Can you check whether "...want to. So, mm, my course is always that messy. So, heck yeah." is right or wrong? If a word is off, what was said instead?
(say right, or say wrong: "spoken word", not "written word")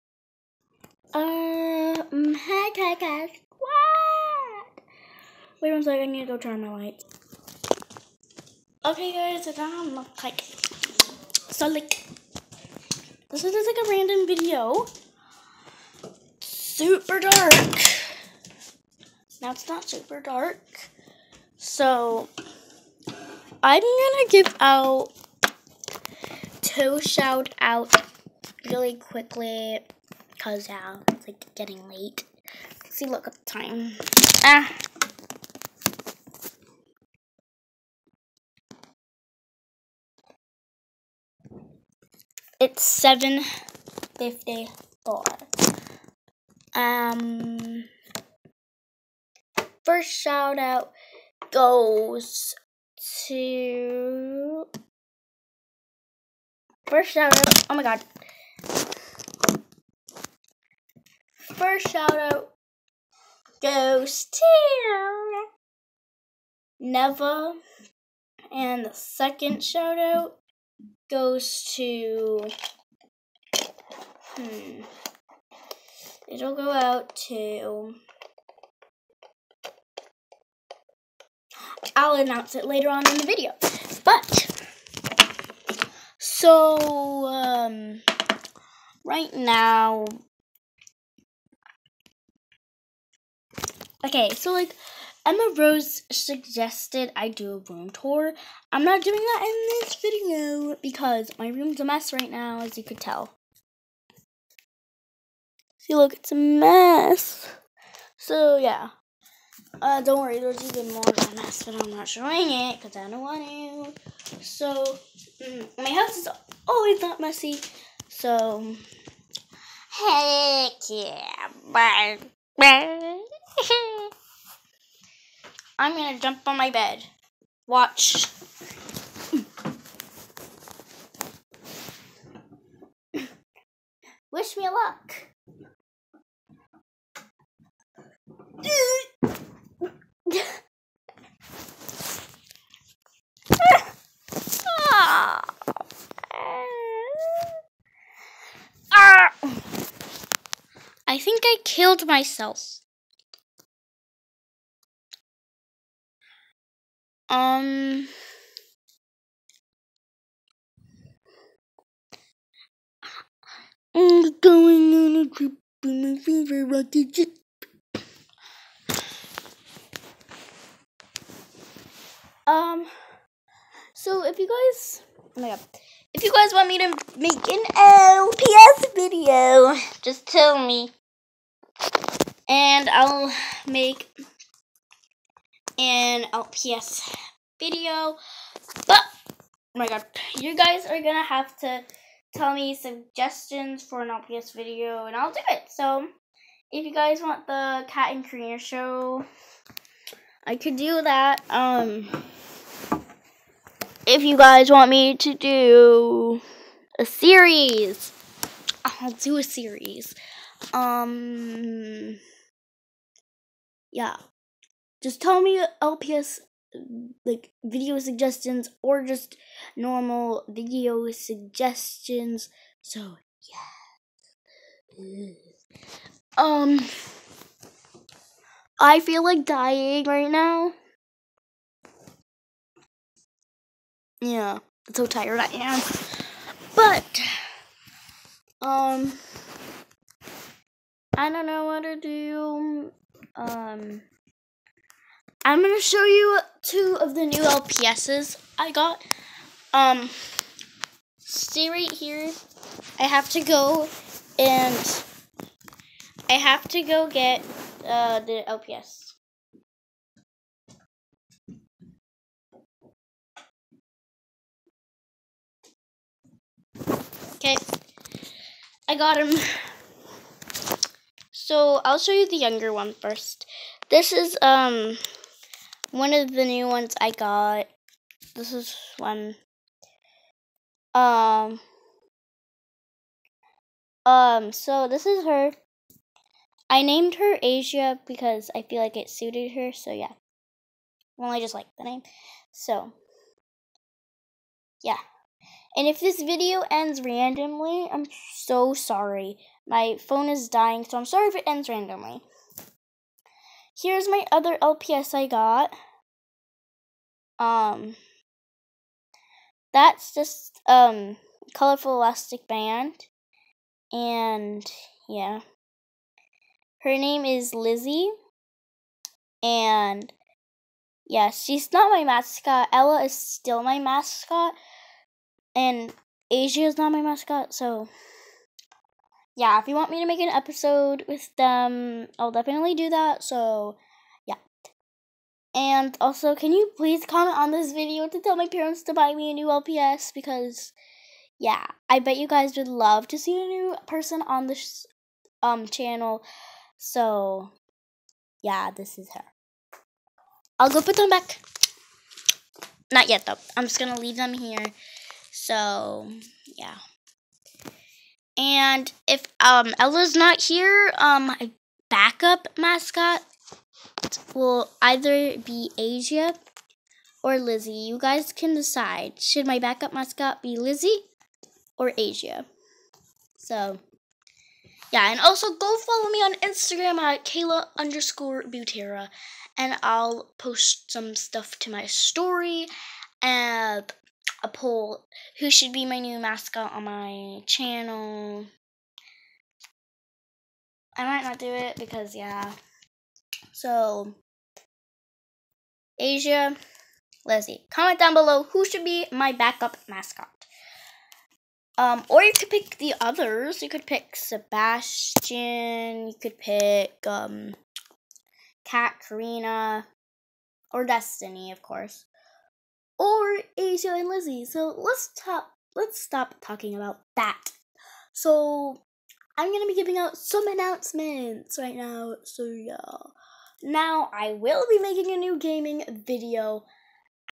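wrong: "house", not "course".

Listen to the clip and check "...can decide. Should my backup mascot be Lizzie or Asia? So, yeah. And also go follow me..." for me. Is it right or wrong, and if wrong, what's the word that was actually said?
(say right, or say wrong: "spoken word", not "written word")
right.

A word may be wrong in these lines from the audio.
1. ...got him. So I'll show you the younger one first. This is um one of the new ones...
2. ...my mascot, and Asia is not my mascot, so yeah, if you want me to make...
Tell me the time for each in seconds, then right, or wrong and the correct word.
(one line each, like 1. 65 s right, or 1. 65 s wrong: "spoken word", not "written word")
1. 268 s right
2. 323 s right.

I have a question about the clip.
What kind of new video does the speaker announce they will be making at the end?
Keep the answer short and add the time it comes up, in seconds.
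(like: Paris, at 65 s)
gaming video, at 425 s.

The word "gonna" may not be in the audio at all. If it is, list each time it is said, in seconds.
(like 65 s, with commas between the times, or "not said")
23 s, 125 s, 419 s.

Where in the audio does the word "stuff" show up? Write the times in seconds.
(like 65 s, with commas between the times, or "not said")
381 s.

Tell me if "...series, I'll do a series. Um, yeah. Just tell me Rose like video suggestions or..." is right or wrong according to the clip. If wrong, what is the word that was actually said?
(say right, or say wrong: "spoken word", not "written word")
wrong: "LPS", not "Rose".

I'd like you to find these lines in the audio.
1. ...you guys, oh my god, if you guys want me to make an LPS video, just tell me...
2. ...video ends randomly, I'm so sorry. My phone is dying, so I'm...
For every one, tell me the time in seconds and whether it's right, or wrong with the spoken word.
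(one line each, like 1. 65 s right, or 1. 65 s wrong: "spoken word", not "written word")
1. 174 s right
2. 296 s right.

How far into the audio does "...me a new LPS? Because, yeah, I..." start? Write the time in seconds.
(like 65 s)
339 s.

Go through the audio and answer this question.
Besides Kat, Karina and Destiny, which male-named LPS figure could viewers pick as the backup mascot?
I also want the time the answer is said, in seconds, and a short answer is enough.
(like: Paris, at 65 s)
Sebastian, at 404 s.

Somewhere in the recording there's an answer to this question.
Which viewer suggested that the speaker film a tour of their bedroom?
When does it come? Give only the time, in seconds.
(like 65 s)
95 s.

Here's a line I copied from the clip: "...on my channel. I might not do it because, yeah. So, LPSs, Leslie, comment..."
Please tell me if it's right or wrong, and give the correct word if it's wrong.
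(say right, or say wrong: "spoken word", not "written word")
wrong: "Asia", not "LPSs".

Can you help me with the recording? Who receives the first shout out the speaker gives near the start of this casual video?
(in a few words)
Neva.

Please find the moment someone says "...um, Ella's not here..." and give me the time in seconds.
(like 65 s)
359 s.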